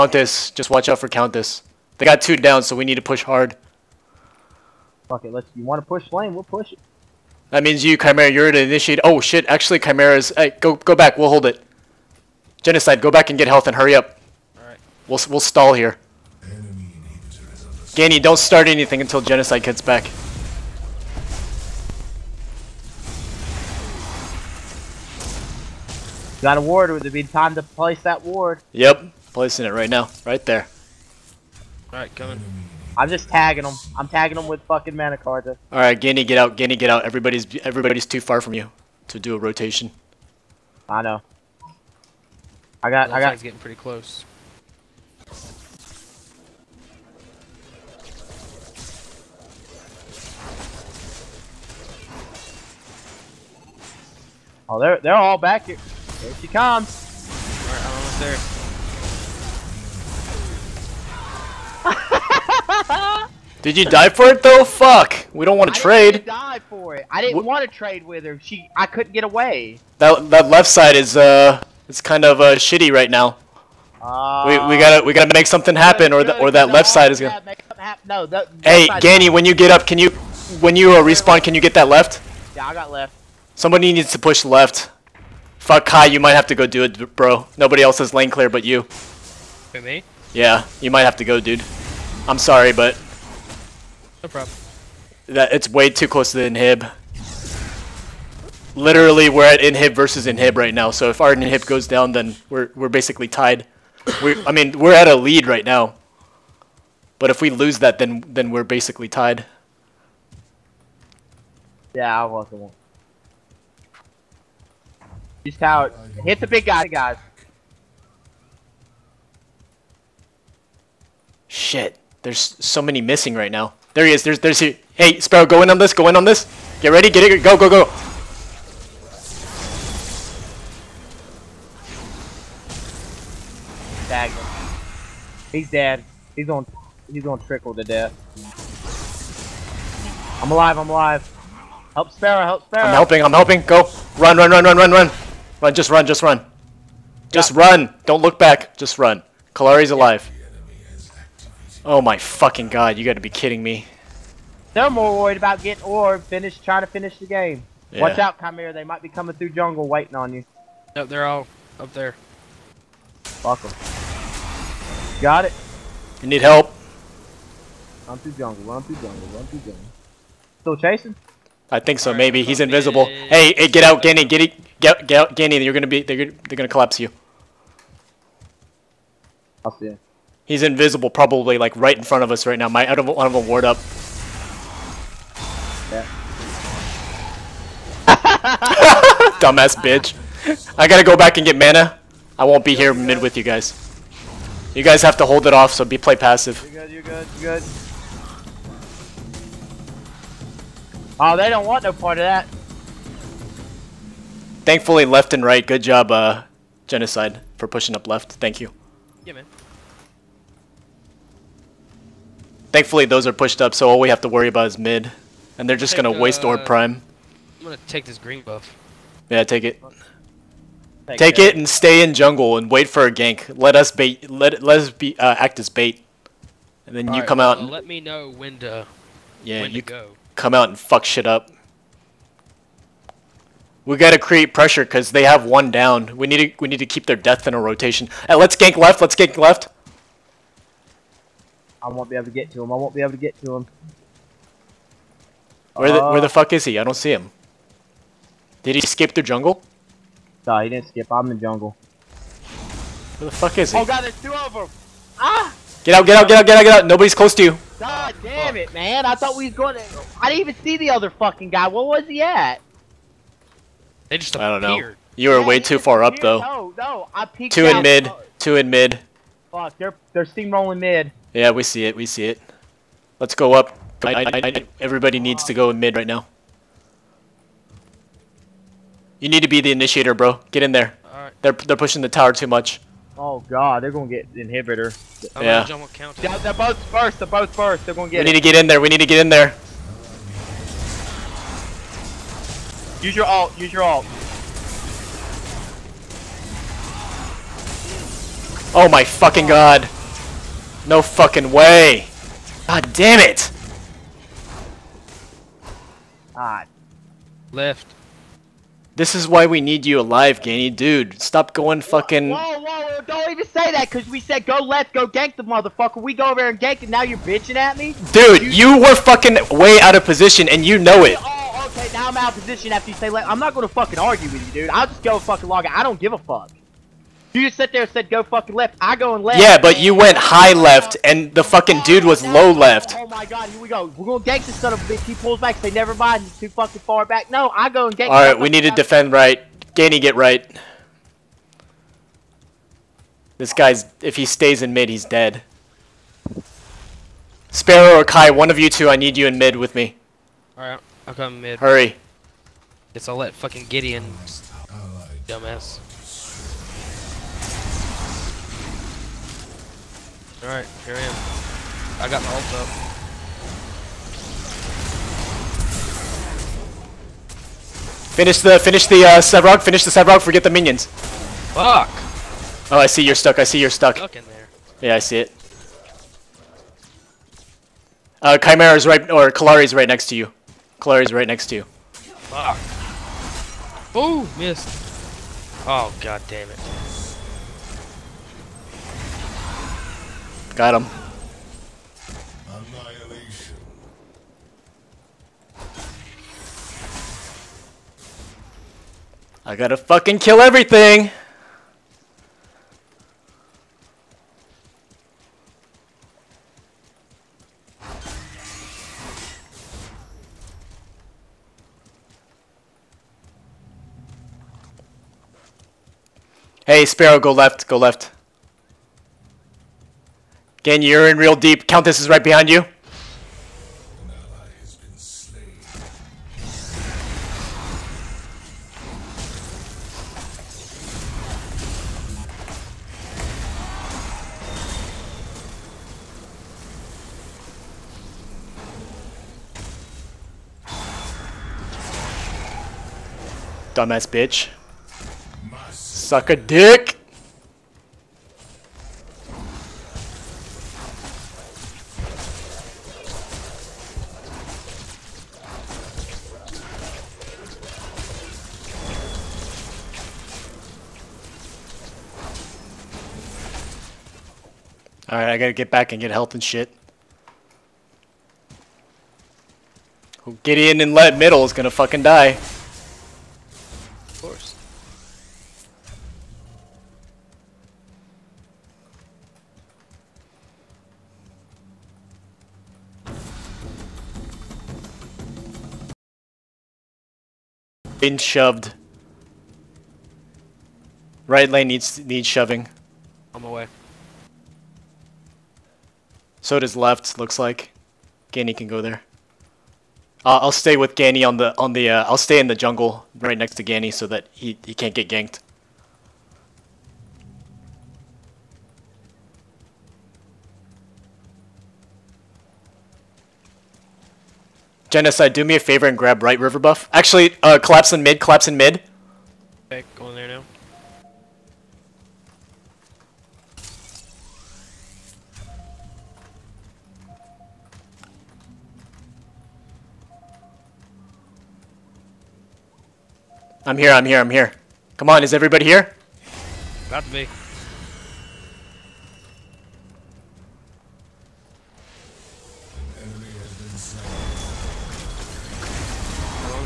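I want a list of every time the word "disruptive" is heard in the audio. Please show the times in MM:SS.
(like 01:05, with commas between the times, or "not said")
not said.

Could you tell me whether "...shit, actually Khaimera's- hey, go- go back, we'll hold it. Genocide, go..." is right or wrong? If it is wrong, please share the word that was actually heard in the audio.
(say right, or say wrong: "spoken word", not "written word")
right.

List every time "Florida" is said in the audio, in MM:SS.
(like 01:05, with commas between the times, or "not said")
not said.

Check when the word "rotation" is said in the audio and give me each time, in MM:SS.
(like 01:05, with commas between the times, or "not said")
00:39, 03:57.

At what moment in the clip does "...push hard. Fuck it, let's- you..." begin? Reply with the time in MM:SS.
00:03.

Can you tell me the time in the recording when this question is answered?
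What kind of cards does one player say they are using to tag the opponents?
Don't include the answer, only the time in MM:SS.
00:34.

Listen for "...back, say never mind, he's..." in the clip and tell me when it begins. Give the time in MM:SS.
05:35.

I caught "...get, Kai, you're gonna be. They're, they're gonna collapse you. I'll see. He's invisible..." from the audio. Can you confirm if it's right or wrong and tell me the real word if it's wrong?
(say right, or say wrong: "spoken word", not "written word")
wrong: "Ganny", not "Kai".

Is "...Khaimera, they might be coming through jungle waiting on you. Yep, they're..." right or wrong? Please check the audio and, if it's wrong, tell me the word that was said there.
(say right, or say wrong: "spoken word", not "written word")
right.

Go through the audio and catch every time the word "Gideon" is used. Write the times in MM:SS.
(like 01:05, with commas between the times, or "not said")
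05:53, 07:50.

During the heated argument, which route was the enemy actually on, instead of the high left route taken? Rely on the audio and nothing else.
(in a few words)
low left.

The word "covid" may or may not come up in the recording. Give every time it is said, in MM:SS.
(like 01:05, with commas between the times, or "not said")
not said.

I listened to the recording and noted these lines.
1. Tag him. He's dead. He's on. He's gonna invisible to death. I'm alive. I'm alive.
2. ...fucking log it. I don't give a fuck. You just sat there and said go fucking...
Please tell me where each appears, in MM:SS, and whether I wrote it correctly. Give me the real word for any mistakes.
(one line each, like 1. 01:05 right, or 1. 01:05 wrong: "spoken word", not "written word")
1. 02:14 wrong: "trickle", not "invisible"
2. 05:25 right.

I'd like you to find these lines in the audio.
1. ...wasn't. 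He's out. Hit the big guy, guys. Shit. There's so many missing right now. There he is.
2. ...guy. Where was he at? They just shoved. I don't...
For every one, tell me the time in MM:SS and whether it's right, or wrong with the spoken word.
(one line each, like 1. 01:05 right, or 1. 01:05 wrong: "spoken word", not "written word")
1. 01:52 right
2. 04:21 wrong: "appeared", not "shoved".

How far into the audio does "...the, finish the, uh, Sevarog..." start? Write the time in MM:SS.
06:08.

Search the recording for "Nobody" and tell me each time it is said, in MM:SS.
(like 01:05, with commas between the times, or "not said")
01:27, 04:16.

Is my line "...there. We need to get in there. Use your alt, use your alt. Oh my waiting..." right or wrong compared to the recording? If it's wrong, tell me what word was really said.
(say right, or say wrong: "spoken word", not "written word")
wrong: "fucking", not "waiting".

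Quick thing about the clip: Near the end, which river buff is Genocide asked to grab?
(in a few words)
right river buff.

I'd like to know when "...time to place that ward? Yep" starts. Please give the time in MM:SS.
00:27.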